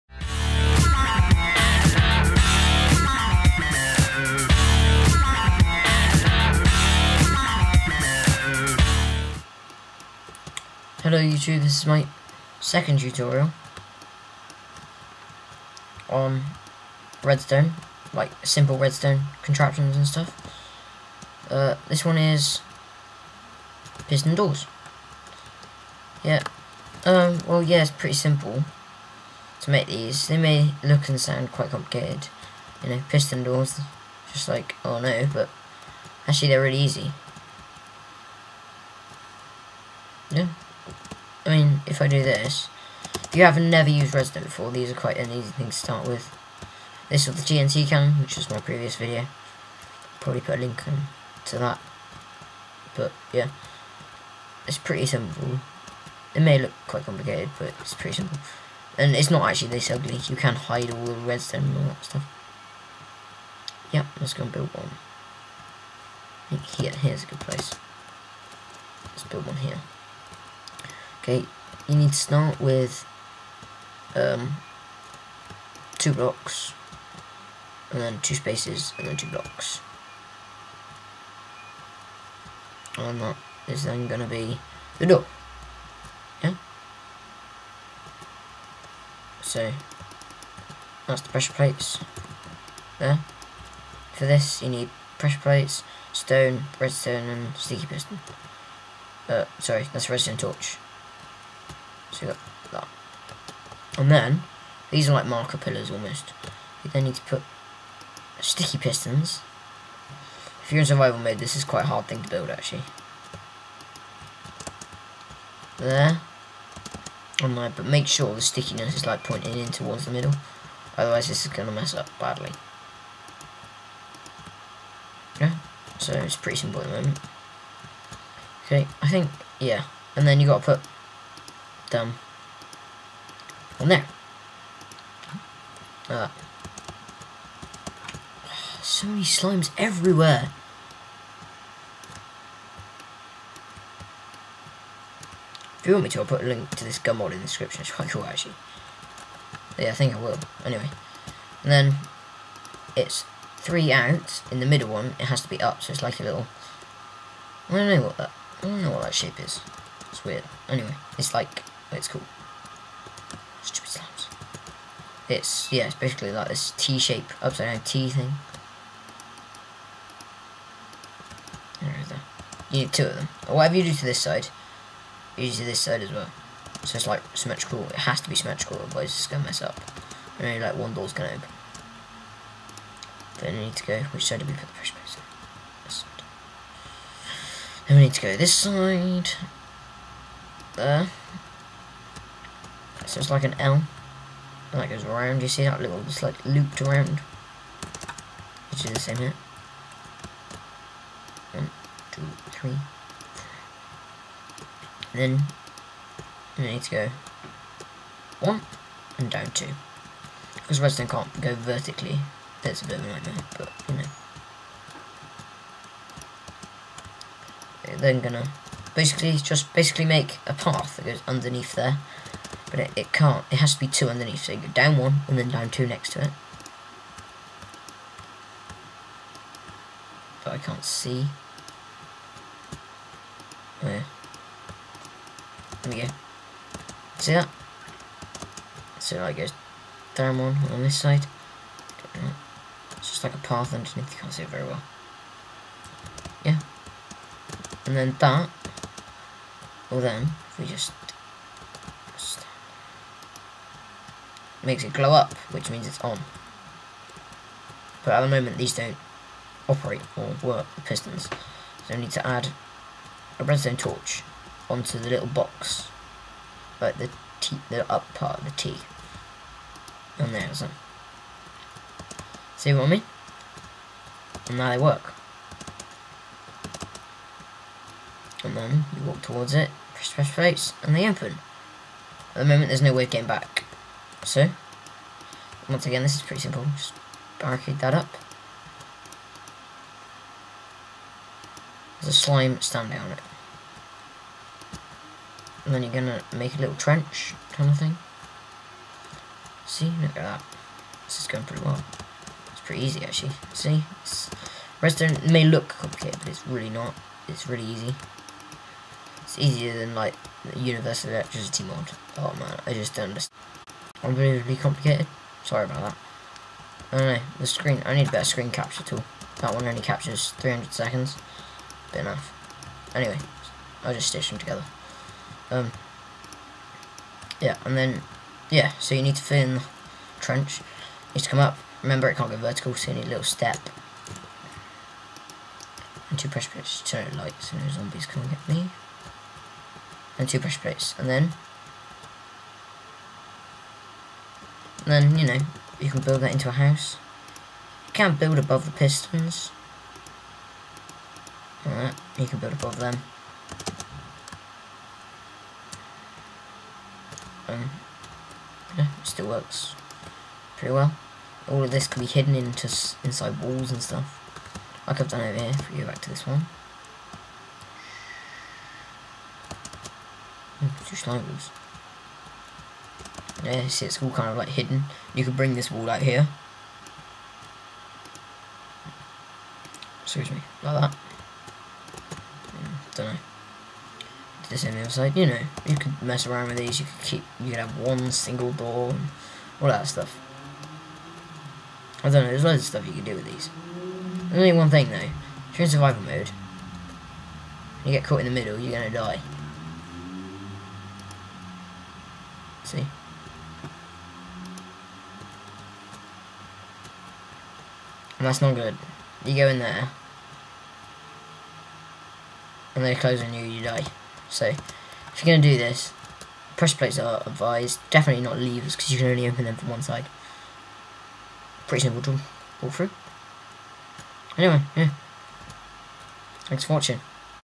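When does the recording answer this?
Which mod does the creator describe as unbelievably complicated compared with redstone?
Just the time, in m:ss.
5:10.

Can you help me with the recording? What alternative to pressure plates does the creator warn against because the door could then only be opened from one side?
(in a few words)
levers.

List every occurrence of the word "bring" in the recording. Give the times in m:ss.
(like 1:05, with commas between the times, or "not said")
6:15.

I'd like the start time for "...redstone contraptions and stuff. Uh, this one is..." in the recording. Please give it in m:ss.
0:18.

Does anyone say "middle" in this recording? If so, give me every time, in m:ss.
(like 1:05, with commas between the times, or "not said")
2:00, 2:34, 6:38.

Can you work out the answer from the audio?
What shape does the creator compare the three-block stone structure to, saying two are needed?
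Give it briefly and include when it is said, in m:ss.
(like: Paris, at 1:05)
upside down T, at 2:47.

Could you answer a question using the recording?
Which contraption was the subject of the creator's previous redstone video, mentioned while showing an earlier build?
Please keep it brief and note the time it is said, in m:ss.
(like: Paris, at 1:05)
TNT cannon, at 0:47.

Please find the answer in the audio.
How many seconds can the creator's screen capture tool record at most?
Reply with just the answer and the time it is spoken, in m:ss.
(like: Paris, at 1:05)
300, at 5:20.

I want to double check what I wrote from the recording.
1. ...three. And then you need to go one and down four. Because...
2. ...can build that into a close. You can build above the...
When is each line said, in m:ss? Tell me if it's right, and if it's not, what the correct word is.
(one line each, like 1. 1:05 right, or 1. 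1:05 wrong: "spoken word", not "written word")
1. 3:22 wrong: "two", not "four"
2. 5:45 wrong: "house", not "close".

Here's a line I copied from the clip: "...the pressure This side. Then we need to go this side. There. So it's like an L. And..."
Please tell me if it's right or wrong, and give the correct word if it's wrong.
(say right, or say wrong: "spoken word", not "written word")
right.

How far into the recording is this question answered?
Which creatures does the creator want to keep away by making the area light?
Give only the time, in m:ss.
5:37.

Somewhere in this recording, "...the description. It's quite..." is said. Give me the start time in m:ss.
2:27.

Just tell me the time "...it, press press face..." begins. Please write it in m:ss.
4:39.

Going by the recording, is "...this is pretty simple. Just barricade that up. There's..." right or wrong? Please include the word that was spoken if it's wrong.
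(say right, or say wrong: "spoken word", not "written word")
right.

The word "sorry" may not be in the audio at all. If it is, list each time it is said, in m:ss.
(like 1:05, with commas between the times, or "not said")
1:39, 5:15.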